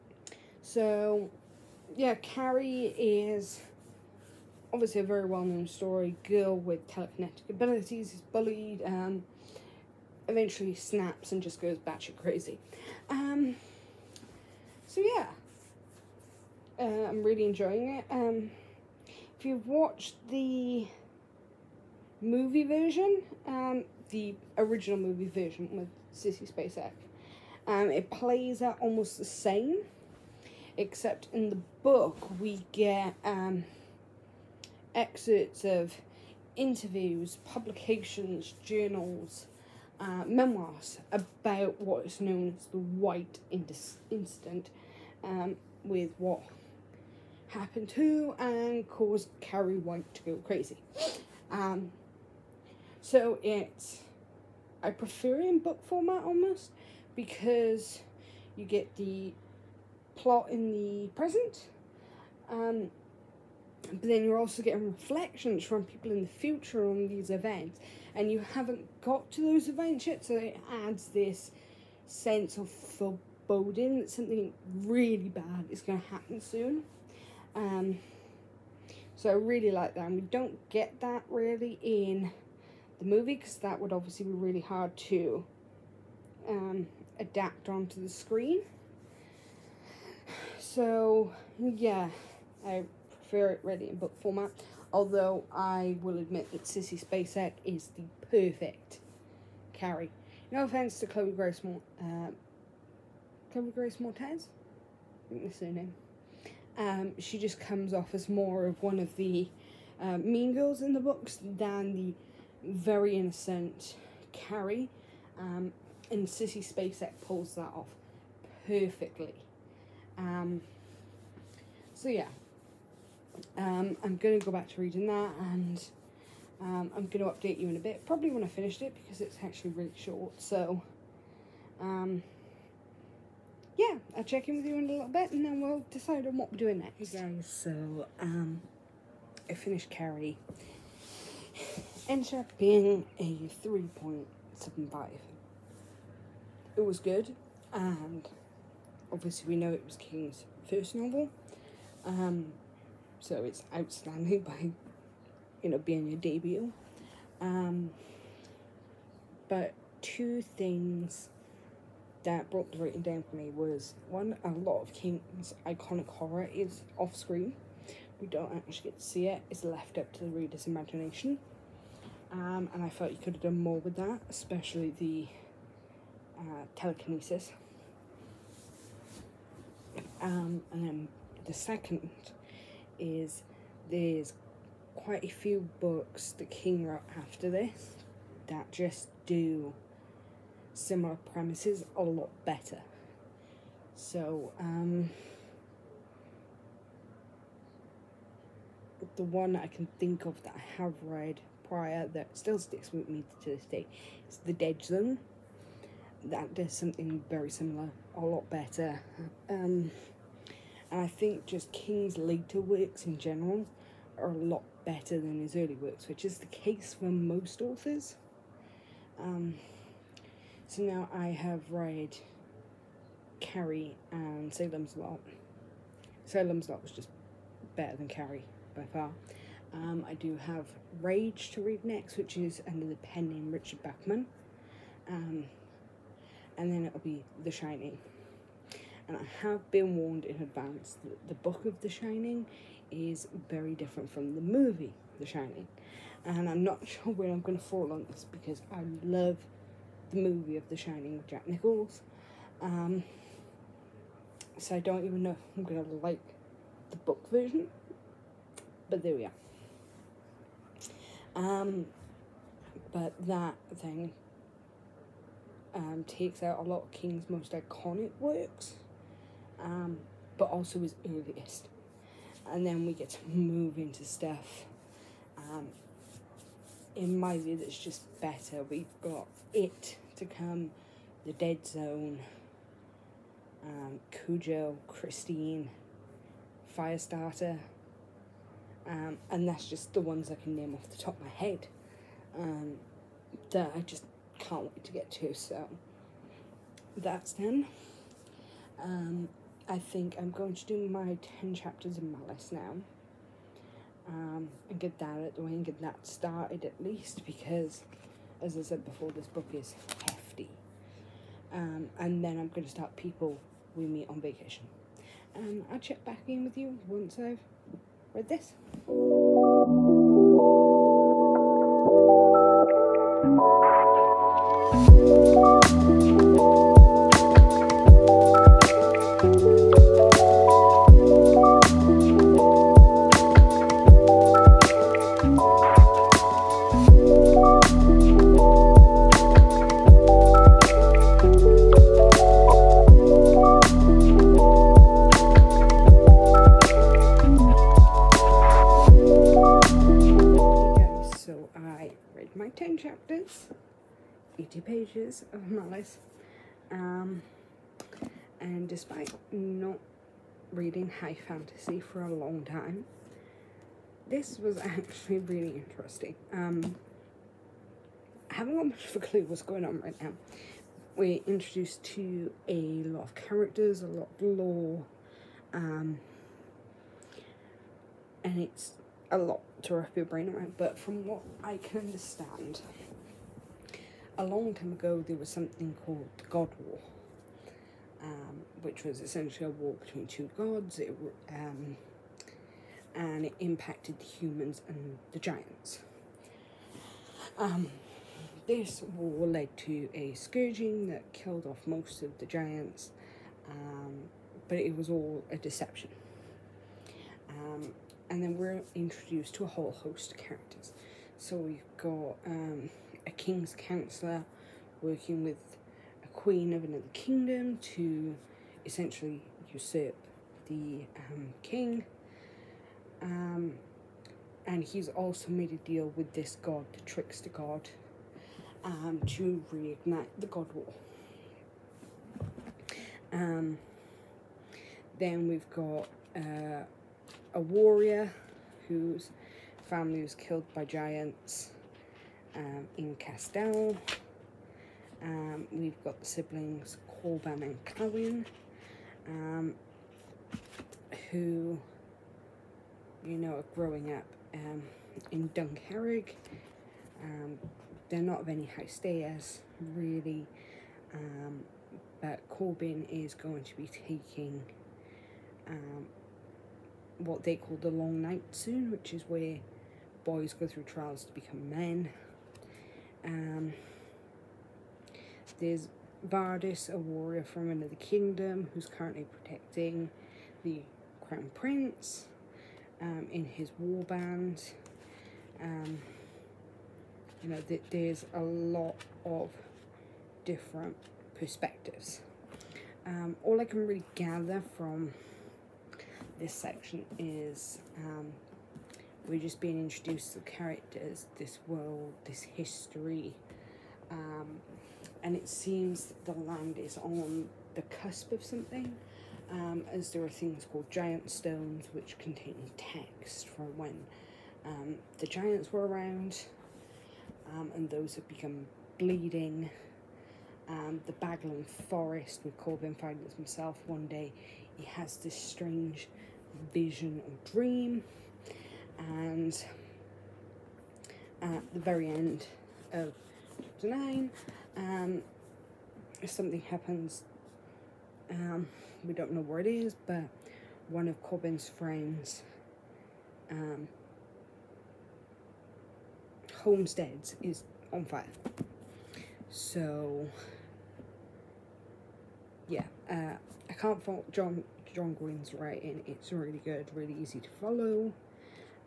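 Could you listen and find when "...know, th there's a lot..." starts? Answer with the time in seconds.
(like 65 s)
487 s.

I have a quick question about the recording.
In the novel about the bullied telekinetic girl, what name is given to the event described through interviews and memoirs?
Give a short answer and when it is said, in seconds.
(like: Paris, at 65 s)
The White Incident, at 42 s.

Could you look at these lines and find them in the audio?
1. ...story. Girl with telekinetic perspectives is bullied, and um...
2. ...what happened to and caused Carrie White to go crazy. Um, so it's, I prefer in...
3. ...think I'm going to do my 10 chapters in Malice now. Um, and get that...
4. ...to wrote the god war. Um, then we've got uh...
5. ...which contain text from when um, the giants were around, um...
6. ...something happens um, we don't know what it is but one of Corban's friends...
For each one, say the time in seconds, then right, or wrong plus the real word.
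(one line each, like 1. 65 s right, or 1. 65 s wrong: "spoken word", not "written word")
1. 5 s wrong: "abilities", not "perspectives"
2. 46 s right
3. 299 s right
4. 429 s wrong: "reignite", not "wrote"
5. 511 s right
6. 536 s right.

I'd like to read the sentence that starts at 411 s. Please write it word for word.
So we've got um, a king's counselor working with a queen of another kingdom to essentially usurp the um, king.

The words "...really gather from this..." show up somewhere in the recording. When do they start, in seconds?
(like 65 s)
493 s.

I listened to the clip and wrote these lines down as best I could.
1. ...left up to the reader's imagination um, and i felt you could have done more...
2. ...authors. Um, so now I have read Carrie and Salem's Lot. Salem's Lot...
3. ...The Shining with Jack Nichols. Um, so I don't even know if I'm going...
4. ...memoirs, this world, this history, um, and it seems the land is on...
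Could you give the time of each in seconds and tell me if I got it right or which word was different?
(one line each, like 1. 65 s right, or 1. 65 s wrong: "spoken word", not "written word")
1. 169 s right
2. 217 s right
3. 250 s right
4. 500 s wrong: "characters", not "memoirs".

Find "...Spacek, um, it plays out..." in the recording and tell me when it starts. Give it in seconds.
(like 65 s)
26 s.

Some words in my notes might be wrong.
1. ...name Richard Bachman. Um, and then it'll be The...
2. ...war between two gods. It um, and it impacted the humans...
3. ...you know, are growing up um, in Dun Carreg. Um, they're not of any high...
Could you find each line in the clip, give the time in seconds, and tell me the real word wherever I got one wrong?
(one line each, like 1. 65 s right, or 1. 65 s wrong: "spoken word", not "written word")
1. 233 s right
2. 389 s right
3. 453 s right.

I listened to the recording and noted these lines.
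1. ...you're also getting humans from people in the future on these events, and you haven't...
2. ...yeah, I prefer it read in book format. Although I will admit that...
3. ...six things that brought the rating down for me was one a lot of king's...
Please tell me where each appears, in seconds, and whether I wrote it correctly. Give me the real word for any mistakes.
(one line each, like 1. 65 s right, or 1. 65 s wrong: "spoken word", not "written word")
1. 64 s wrong: "reflections", not "humans"
2. 91 s right
3. 160 s wrong: "two", not "six".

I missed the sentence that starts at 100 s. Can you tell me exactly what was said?
No offense to Chloe Grace Mort, uh, um, Chloe Grace Moretz.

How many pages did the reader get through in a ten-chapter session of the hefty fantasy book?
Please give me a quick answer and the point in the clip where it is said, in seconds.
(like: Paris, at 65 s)
80, at 354 s.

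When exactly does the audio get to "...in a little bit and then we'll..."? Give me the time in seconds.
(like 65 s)
134 s.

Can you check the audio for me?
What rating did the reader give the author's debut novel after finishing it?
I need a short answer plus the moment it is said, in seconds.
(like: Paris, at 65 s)
3.75, at 143 s.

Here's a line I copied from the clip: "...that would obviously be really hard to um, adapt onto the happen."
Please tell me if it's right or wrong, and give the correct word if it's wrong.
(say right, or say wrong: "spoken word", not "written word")
wrong: "screen", not "happen".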